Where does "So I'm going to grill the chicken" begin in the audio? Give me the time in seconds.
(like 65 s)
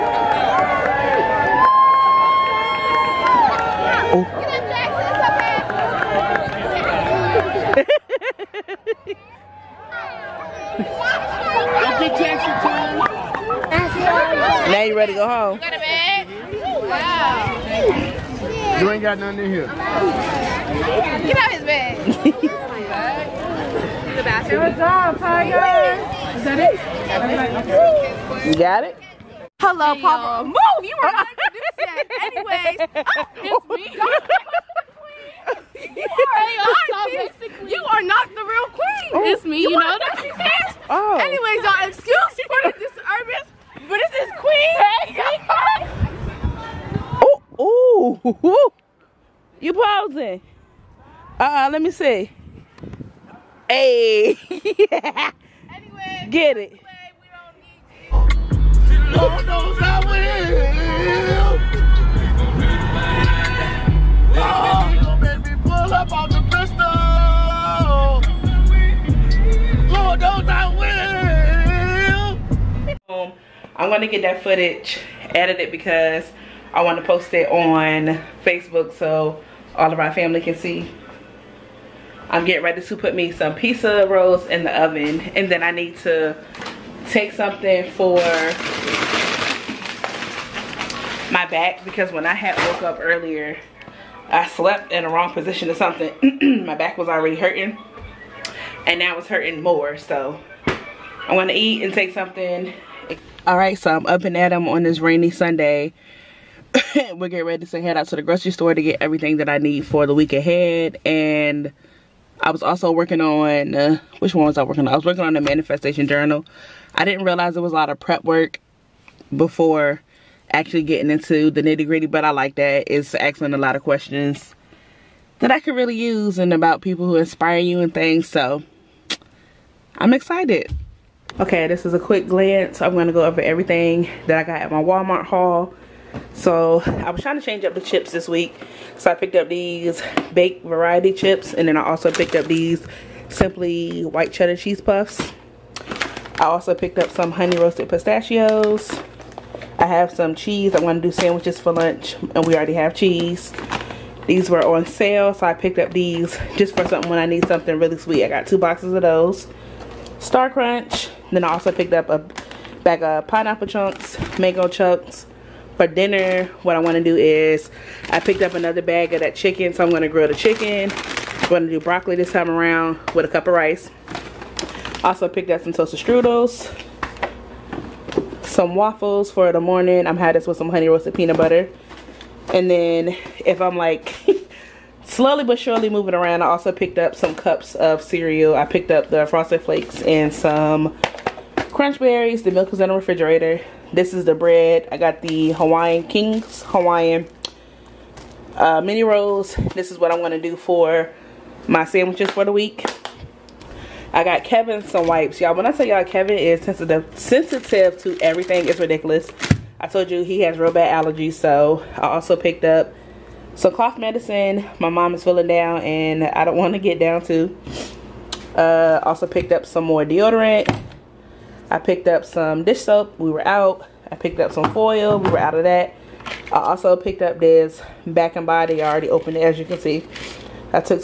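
169 s.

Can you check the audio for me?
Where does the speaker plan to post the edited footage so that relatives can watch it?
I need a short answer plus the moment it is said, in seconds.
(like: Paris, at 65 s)
Facebook, at 78 s.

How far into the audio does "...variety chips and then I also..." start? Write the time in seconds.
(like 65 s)
140 s.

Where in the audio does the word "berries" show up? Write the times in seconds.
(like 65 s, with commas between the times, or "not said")
191 s.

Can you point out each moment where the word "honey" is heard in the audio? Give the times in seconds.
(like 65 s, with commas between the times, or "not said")
147 s, 180 s.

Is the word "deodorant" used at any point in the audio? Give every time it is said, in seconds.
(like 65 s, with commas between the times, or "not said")
220 s.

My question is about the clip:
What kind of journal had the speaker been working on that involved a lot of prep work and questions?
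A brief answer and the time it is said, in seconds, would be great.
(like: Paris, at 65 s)
manifestation journal, at 115 s.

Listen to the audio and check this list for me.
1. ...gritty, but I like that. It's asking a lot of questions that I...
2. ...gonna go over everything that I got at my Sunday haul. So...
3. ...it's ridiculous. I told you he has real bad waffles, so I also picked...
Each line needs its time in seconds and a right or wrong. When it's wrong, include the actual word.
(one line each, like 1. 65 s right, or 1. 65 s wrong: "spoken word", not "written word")
1. 121 s right
2. 132 s wrong: "Walmart", not "Sunday"
3. 208 s wrong: "allergies", not "waffles".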